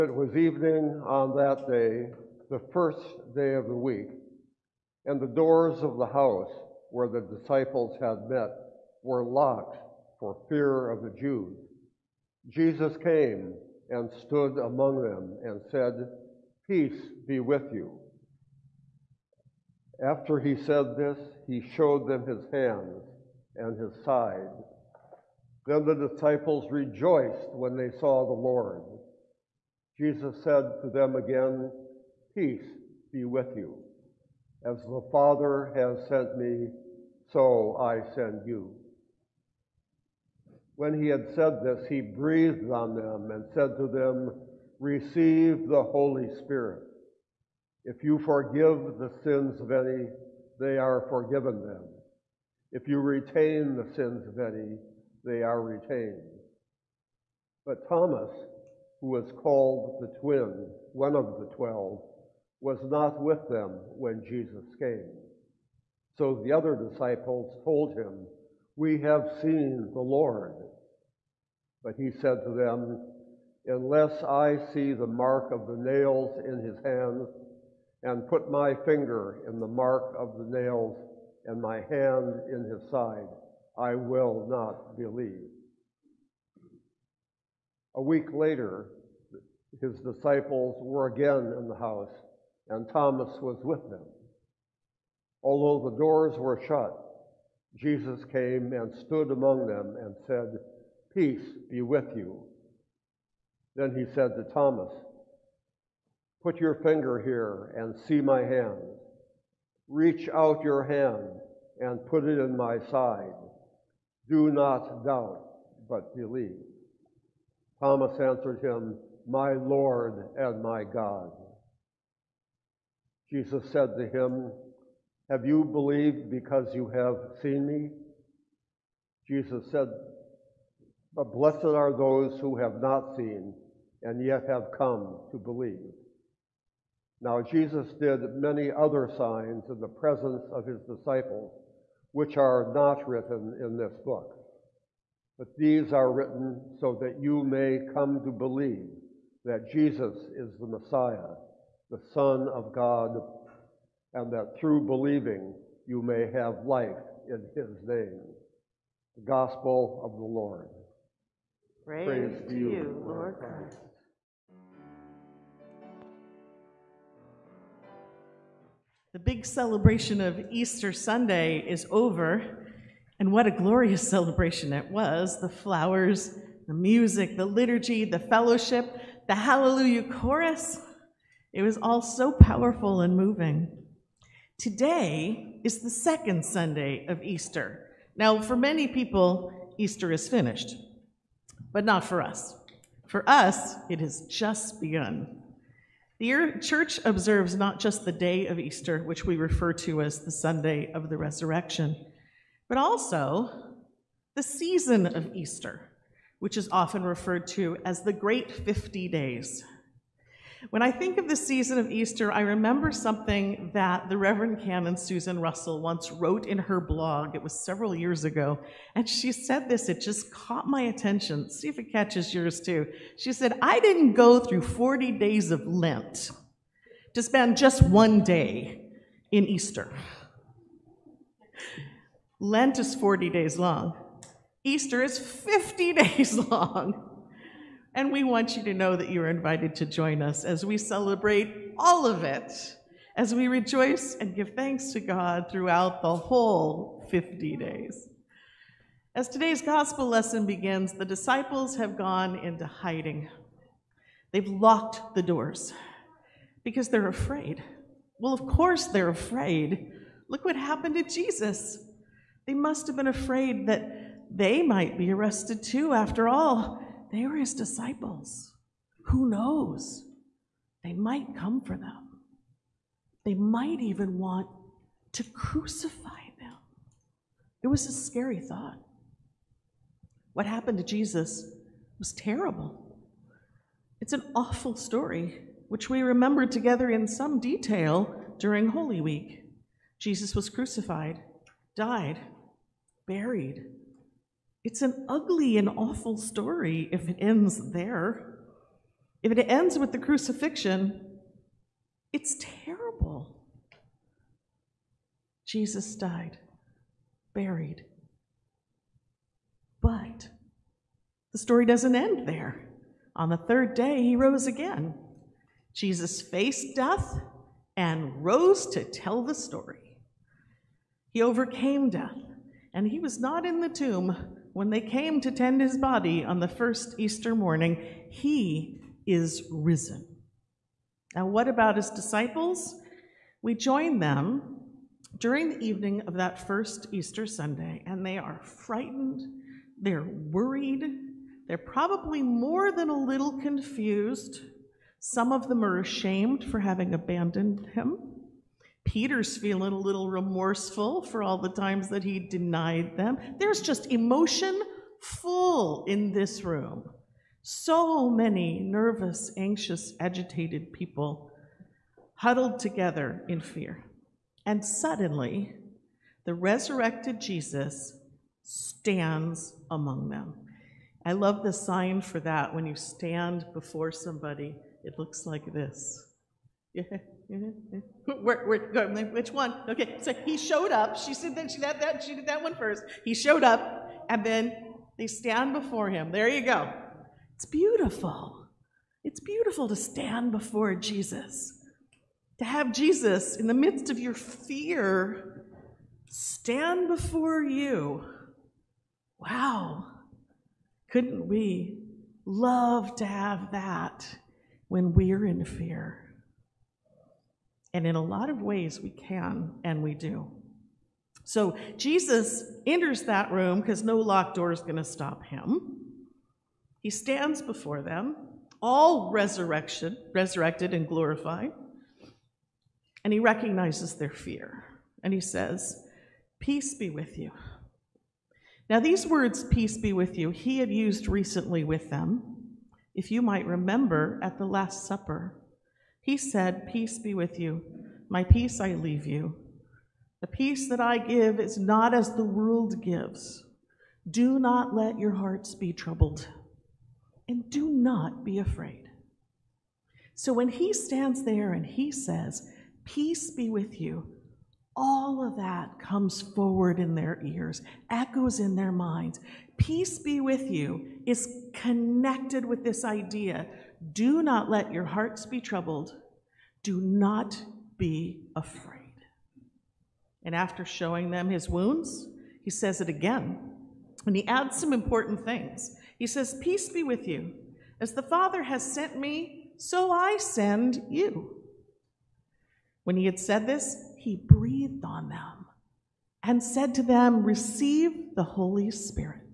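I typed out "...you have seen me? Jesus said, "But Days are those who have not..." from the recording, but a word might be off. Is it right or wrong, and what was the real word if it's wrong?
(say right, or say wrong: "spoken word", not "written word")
wrong: "Blessed", not "Days".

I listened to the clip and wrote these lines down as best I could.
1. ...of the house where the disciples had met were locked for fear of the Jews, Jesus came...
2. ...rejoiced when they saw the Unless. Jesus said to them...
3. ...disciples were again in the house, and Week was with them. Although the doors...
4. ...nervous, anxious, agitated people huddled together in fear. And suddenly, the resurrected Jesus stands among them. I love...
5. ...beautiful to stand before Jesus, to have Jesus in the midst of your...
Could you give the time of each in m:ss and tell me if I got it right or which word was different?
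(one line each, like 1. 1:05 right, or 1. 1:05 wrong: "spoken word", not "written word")
1. 0:05 right
2. 0:26 wrong: "Lord", not "Unless"
3. 1:29 wrong: "Thomas", not "Week"
4. 5:58 right
5. 6:29 right.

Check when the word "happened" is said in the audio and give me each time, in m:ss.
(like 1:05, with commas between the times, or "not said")
4:20, 4:40.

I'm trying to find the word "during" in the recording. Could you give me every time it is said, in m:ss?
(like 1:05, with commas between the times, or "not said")
4:48, 5:35.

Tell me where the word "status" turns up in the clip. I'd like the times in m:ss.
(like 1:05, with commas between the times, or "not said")
not said.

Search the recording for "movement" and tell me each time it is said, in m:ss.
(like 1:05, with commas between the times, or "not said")
not said.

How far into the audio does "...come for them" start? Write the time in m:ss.
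4:31.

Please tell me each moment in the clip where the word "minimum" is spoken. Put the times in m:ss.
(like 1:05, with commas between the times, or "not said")
not said.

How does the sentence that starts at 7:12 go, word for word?
If you might remember at the Last Supper, he said, Peace be with you.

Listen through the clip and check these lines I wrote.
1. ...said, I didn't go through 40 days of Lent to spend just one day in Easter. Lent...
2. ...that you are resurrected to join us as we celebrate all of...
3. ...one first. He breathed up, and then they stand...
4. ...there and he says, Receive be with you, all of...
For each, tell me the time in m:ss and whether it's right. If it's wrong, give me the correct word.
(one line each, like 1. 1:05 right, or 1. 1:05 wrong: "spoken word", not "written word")
1. 3:43 right
2. 3:58 wrong: "invited", not "resurrected"
3. 6:22 wrong: "showed", not "breathed"
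4. 7:31 wrong: "Peace", not "Receive".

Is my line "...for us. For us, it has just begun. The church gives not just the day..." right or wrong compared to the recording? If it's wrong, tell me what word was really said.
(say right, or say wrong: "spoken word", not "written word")
wrong: "observes", not "gives".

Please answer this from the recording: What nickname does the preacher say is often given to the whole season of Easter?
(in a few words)
The Great 50 Days.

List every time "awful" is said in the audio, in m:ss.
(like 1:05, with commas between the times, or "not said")
4:44, 4:55.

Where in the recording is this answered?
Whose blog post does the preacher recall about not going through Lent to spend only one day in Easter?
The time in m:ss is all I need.
3:34.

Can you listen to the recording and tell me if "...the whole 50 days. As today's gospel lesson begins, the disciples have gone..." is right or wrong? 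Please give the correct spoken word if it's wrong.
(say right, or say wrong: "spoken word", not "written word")
right.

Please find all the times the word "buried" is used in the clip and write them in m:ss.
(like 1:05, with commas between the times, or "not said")
4:53, 5:07.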